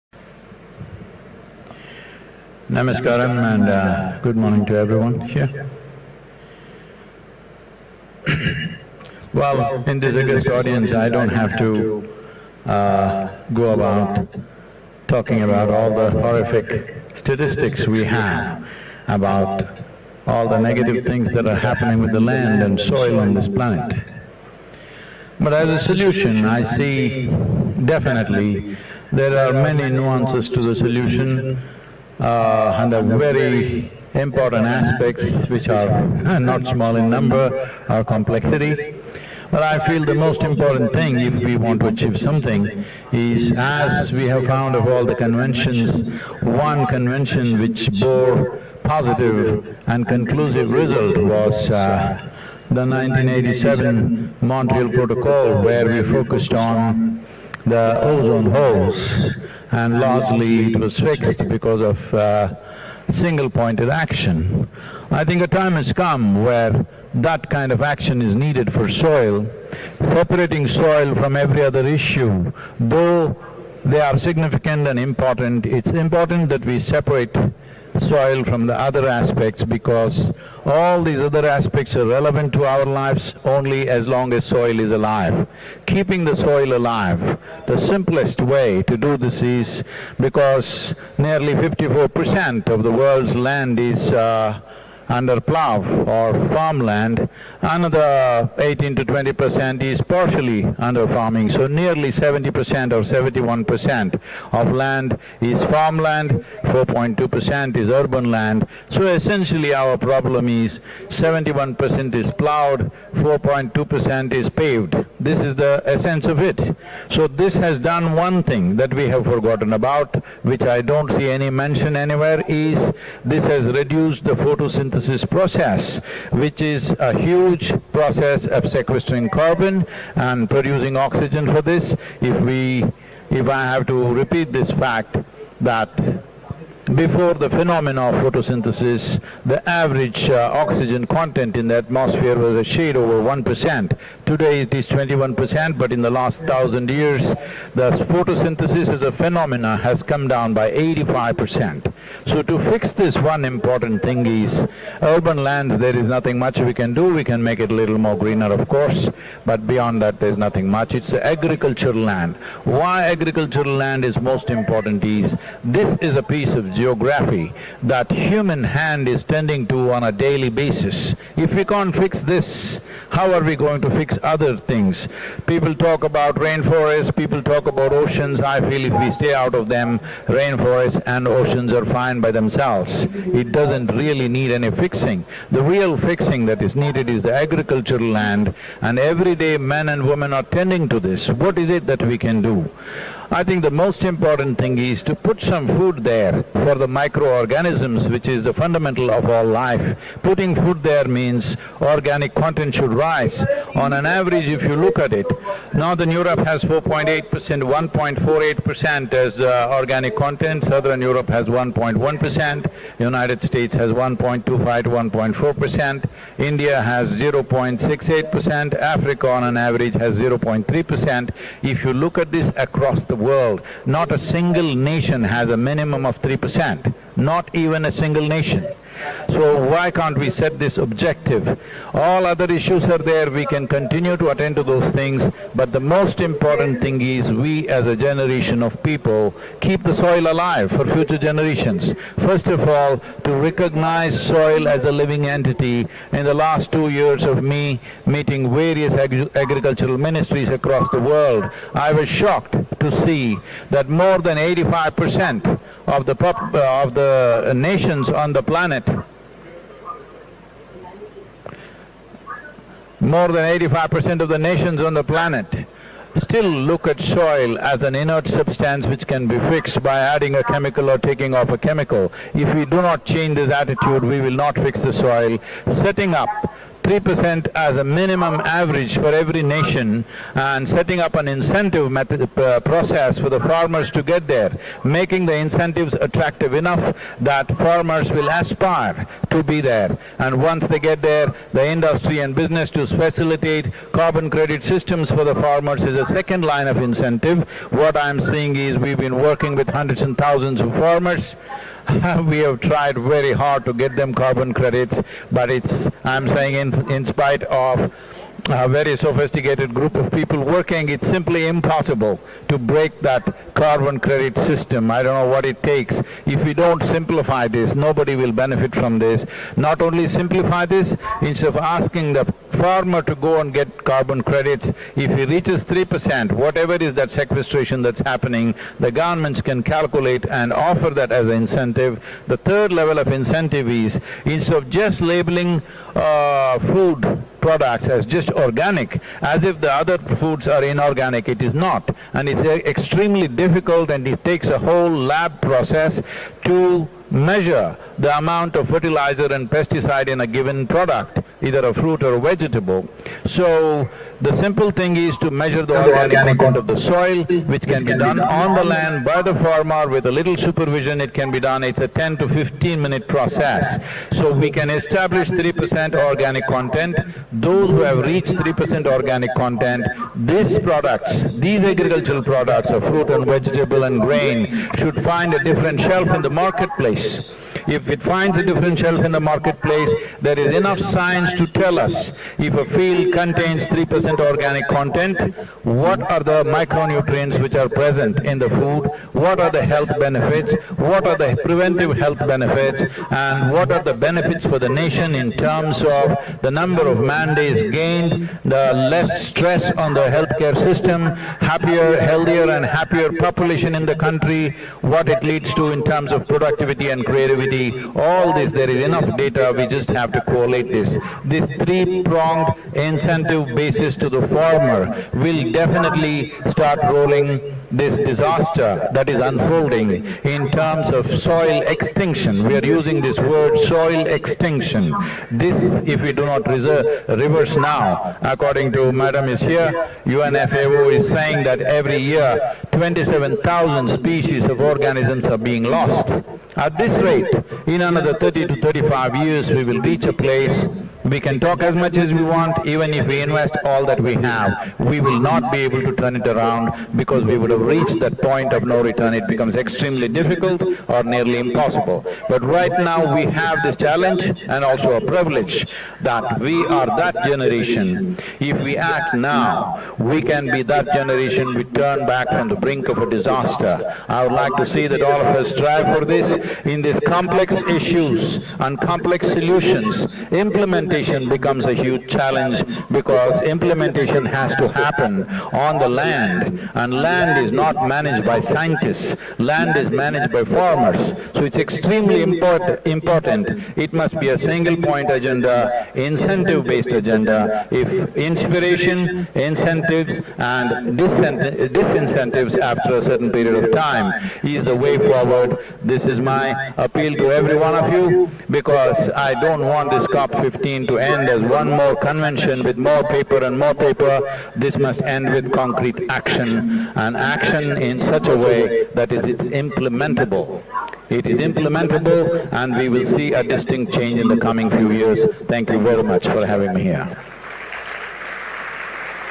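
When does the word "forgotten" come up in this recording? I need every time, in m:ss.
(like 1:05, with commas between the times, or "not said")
1:59.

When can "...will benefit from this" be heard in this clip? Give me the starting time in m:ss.
5:18.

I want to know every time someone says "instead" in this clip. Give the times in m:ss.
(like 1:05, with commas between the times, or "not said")
5:21, 5:34.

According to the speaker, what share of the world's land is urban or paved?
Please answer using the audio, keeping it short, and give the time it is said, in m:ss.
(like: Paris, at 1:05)
4.2 percent, at 1:46.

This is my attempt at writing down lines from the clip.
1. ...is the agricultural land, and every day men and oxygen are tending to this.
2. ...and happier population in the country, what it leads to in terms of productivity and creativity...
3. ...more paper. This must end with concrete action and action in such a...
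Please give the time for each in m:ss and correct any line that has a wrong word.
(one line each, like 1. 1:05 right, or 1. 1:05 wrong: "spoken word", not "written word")
1. 3:07 wrong: "women", not "oxygen"
2. 6:42 right
3. 8:23 right.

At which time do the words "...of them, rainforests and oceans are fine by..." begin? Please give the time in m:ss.
2:59.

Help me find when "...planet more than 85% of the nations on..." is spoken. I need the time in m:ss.
4:18.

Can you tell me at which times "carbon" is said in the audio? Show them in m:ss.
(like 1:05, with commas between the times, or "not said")
2:09, 4:53, 5:04, 5:13, 5:23.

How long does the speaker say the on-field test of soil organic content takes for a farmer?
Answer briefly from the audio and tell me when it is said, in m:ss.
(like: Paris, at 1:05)
10 to 15 minutes, at 6:01.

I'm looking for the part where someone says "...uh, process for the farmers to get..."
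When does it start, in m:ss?
4:42.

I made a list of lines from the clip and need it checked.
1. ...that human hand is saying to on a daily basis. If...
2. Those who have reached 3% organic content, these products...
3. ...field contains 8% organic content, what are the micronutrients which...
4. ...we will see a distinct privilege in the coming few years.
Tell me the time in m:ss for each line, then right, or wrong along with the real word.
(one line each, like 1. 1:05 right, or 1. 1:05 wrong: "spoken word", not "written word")
1. 2:47 wrong: "tending", not "saying"
2. 6:07 right
3. 6:22 wrong: "3", not "8"
4. 8:32 wrong: "change", not "privilege".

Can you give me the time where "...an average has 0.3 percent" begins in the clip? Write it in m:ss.
3:39.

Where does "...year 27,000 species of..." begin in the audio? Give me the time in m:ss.
7:11.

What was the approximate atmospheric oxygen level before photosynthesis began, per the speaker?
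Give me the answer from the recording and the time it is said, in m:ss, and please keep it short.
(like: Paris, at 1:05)
a shade over 1%, at 2:22.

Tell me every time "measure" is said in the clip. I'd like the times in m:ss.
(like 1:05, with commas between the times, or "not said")
5:47, 5:55.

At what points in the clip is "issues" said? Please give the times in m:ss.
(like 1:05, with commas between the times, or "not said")
1:11, 3:52, 7:47.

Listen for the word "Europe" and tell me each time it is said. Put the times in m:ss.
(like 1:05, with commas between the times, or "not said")
3:26, 3:31.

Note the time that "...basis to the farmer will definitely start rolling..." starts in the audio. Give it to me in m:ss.
6:53.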